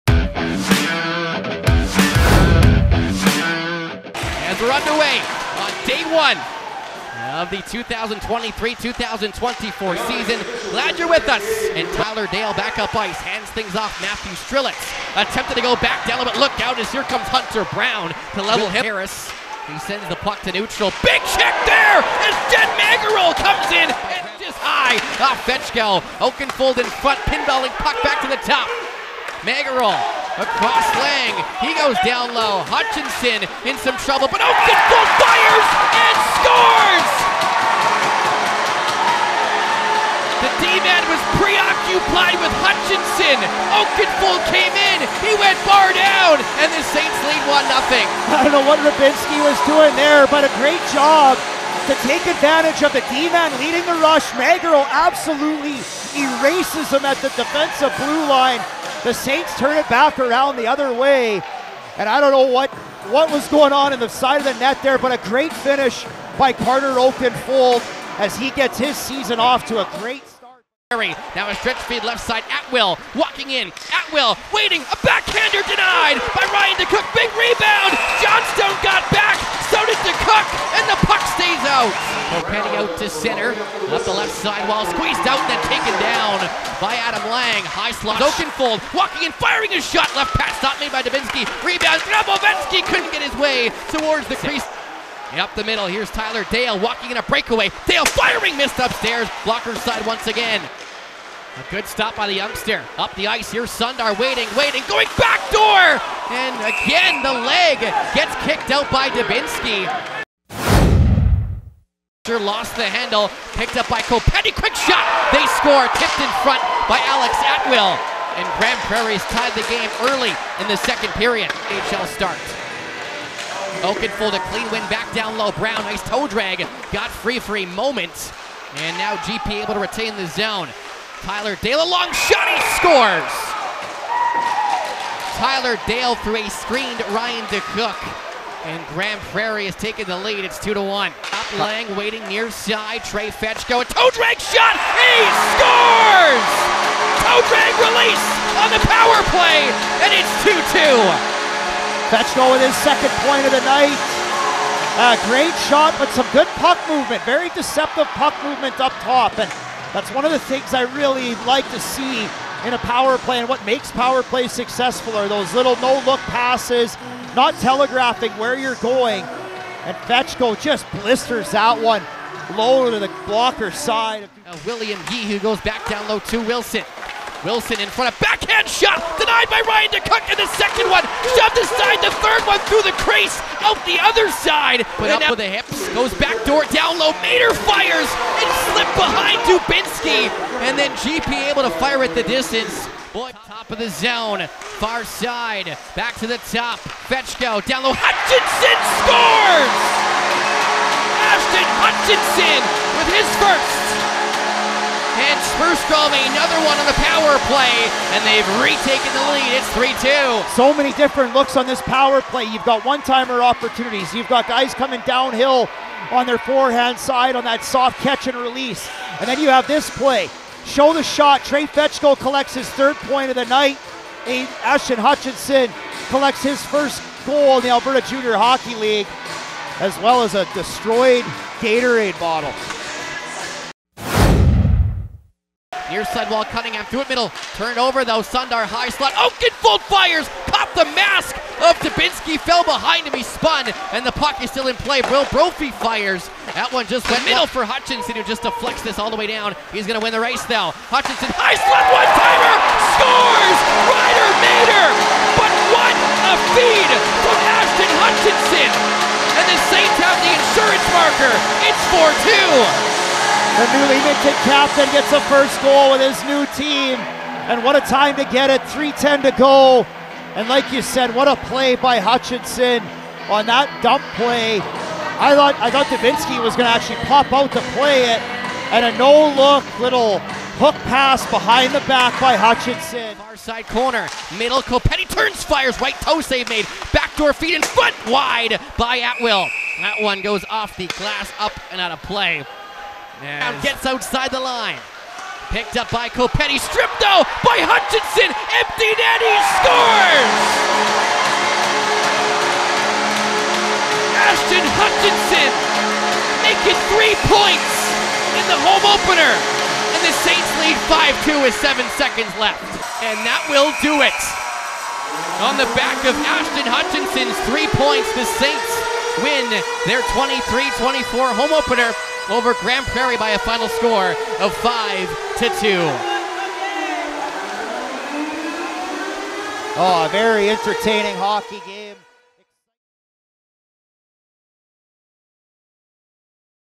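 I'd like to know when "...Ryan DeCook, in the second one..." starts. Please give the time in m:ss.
2:59.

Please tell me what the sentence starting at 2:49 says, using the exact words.
And Fetchko just blisters that one low to the blocker side.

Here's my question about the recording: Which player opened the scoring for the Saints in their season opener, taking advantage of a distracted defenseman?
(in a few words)
Carter Oakenfold.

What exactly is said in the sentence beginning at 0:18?
Harris, he sends the puck to neutral.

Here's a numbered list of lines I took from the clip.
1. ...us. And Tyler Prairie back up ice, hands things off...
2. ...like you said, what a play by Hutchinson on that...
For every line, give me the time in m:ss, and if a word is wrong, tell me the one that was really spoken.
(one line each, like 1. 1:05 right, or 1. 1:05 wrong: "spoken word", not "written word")
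1. 0:11 wrong: "Dale", not "Prairie"
2. 4:30 right.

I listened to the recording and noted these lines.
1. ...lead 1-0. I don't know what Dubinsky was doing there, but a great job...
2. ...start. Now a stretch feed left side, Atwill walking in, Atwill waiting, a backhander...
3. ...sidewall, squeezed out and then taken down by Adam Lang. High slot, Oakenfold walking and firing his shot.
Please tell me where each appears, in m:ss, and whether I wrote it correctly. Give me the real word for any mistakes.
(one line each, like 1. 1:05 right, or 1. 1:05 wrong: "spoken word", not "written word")
1. 0:47 right
2. 1:10 right
3. 1:24 right.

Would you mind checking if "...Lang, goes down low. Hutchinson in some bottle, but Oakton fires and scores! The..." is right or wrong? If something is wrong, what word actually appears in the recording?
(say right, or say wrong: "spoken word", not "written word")
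wrong: "trouble", not "bottle".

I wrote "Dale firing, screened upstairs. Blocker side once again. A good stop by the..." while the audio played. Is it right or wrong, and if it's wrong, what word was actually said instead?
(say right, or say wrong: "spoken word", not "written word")
wrong: "missed", not "screened".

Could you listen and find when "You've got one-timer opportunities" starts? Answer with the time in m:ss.
3:32.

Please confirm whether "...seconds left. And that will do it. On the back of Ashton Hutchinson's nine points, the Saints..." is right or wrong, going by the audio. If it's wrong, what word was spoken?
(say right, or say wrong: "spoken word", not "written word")
wrong: "three", not "nine".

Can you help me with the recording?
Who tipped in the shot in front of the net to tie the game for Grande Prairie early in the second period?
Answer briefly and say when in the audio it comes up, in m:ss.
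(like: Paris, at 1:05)
Alex Atwill, at 1:57.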